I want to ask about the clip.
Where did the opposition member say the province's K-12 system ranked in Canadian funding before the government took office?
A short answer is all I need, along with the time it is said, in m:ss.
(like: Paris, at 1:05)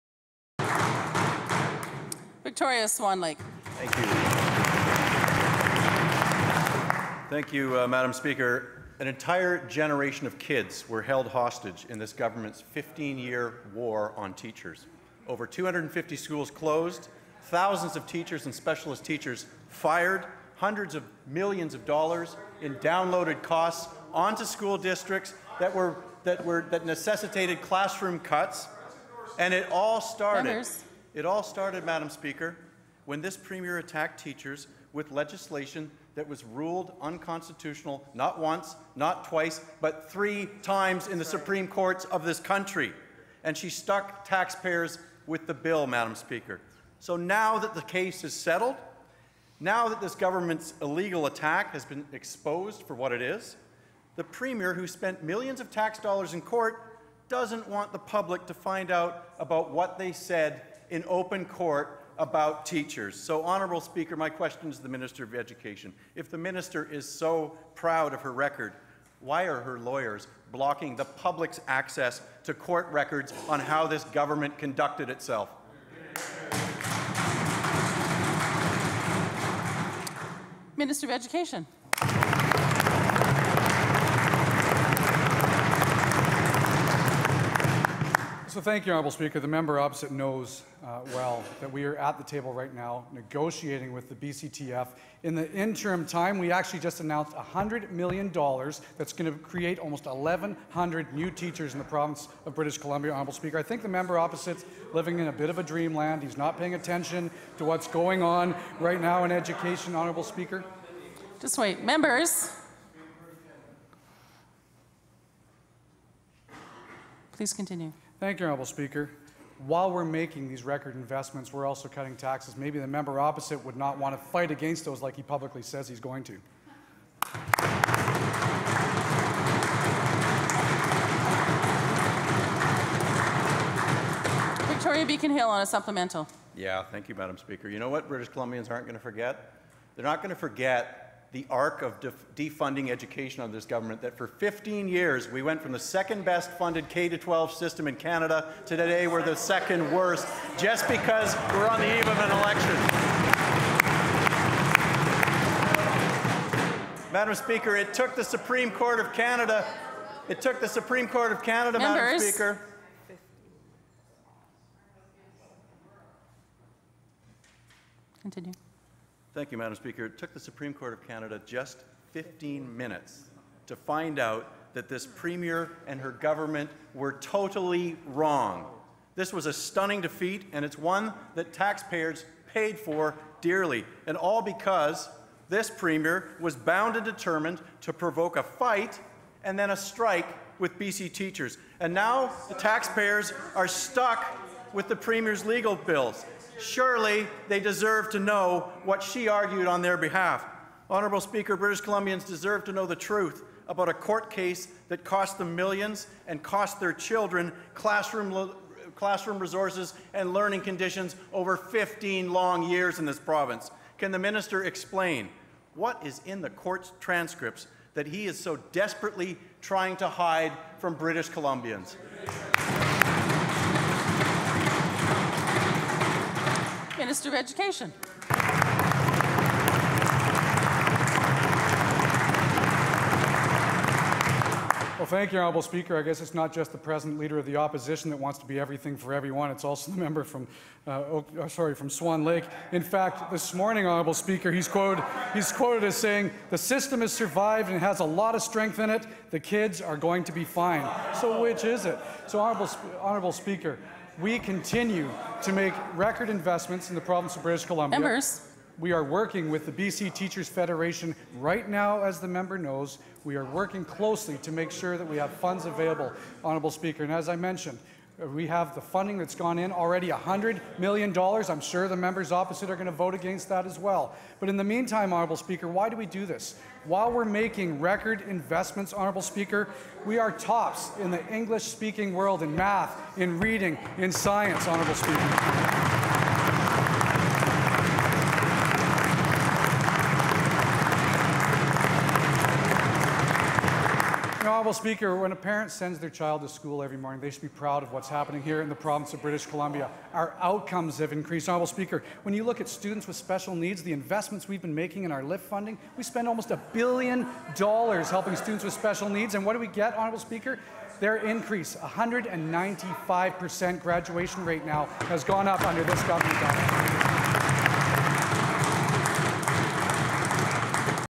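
Second best, at 2:25.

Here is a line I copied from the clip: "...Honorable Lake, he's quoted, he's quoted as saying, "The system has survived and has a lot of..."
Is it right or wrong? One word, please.
wrong.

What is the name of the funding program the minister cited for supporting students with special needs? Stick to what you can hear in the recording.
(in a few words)
LIFT.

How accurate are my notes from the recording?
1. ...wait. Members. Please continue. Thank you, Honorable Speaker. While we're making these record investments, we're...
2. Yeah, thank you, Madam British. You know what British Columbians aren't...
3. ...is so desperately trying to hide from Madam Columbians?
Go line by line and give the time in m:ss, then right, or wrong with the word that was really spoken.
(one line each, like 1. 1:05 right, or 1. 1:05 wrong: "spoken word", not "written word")
1. 1:51 right
2. 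2:16 wrong: "Speaker", not "British"
3. 3:38 wrong: "British", not "Madam".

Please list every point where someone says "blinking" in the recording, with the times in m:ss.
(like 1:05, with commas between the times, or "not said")
not said.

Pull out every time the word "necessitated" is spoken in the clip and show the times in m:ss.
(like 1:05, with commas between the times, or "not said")
0:26.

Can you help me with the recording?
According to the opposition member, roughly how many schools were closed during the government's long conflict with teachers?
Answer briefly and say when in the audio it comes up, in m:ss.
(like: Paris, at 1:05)
Over 250, at 0:15.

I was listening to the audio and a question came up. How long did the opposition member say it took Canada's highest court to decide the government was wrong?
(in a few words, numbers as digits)
15 minutes.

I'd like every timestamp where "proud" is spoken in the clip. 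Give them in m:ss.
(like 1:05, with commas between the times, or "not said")
1:07, 4:57.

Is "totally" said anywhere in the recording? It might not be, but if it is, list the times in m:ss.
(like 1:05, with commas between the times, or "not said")
2:57.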